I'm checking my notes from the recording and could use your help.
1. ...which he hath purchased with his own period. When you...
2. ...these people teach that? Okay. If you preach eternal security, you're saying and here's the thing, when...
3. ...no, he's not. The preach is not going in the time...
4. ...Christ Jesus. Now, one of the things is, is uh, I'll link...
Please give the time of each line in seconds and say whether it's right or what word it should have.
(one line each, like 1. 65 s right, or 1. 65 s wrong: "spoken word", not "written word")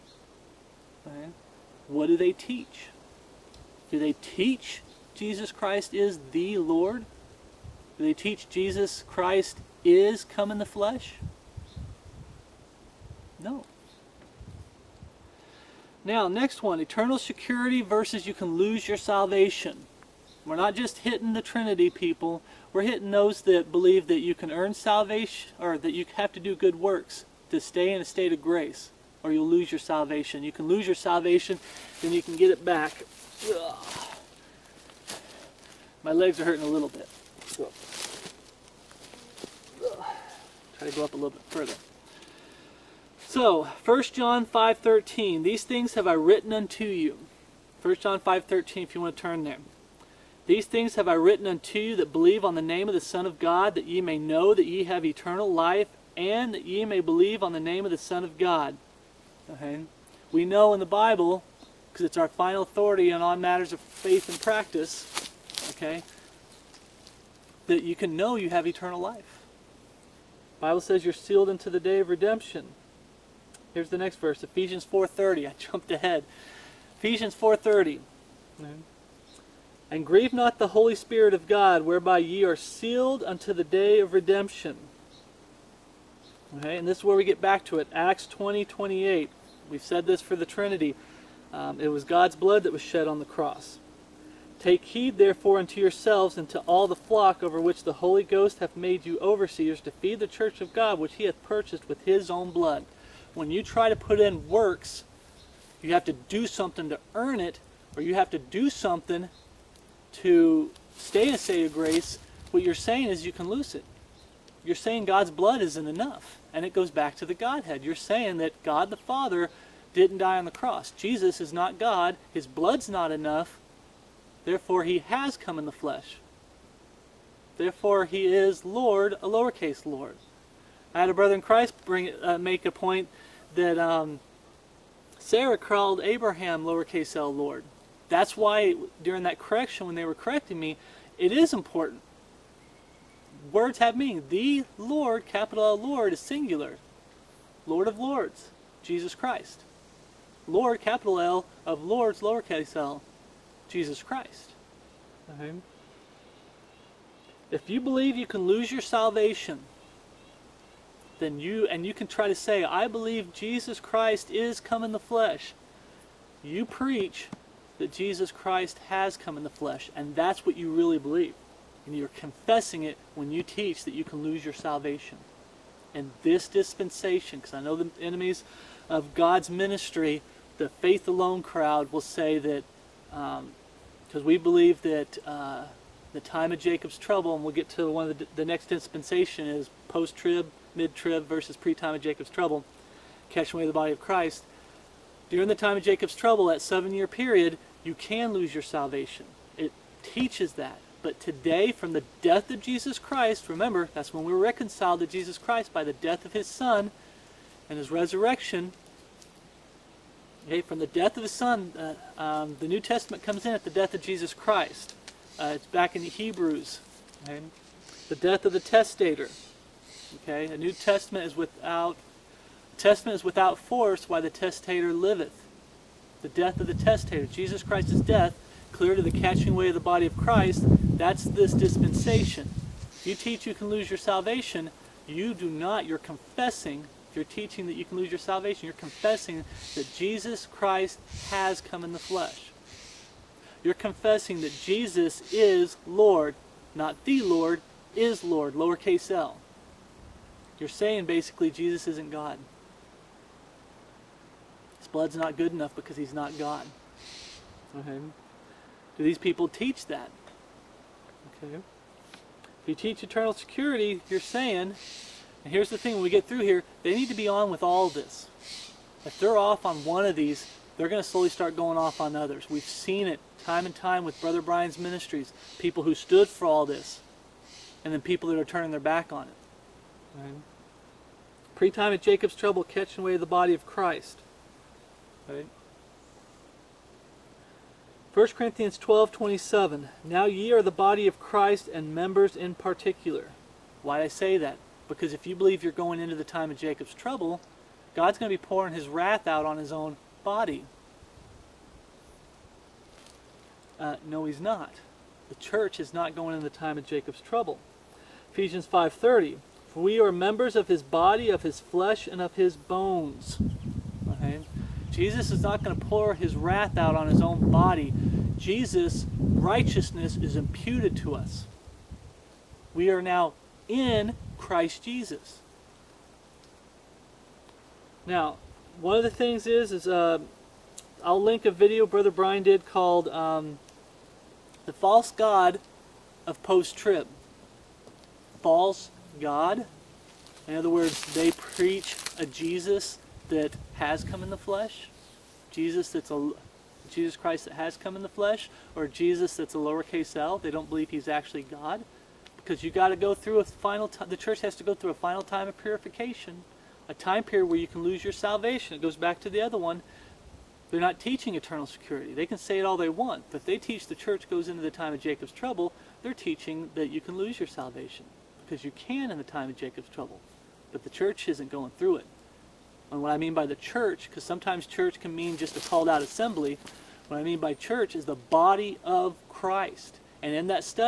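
1. 100 s wrong: "blood", not "period"
2. 259 s wrong: "teach", not "preach"
3. 304 s wrong: "church", not "preach"
4. 324 s right.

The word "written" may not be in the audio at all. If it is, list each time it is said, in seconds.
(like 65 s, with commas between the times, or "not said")
46 s, 51 s.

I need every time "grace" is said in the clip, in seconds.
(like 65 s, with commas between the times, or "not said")
28 s, 111 s.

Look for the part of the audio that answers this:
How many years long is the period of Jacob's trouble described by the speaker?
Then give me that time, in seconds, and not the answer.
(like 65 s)
196 s.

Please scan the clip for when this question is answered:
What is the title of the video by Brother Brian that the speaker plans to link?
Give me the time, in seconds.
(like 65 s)
334 s.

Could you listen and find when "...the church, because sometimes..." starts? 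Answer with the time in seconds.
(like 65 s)
373 s.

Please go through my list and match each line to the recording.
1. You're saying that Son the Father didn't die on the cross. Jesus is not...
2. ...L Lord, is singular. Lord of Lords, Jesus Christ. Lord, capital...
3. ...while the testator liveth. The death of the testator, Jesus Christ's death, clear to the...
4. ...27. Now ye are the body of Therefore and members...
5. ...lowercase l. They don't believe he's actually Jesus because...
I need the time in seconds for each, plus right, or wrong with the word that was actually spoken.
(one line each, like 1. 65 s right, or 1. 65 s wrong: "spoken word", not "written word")
1. 117 s wrong: "God", not "Son"
2. 145 s right
3. 224 s right
4. 289 s wrong: "Christ", not "Therefore"
5. 349 s wrong: "God", not "Jesus".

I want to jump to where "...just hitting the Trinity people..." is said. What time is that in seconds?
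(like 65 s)
20 s.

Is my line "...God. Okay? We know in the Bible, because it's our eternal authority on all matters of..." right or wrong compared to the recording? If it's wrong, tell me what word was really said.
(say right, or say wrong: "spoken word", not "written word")
wrong: "final", not "eternal".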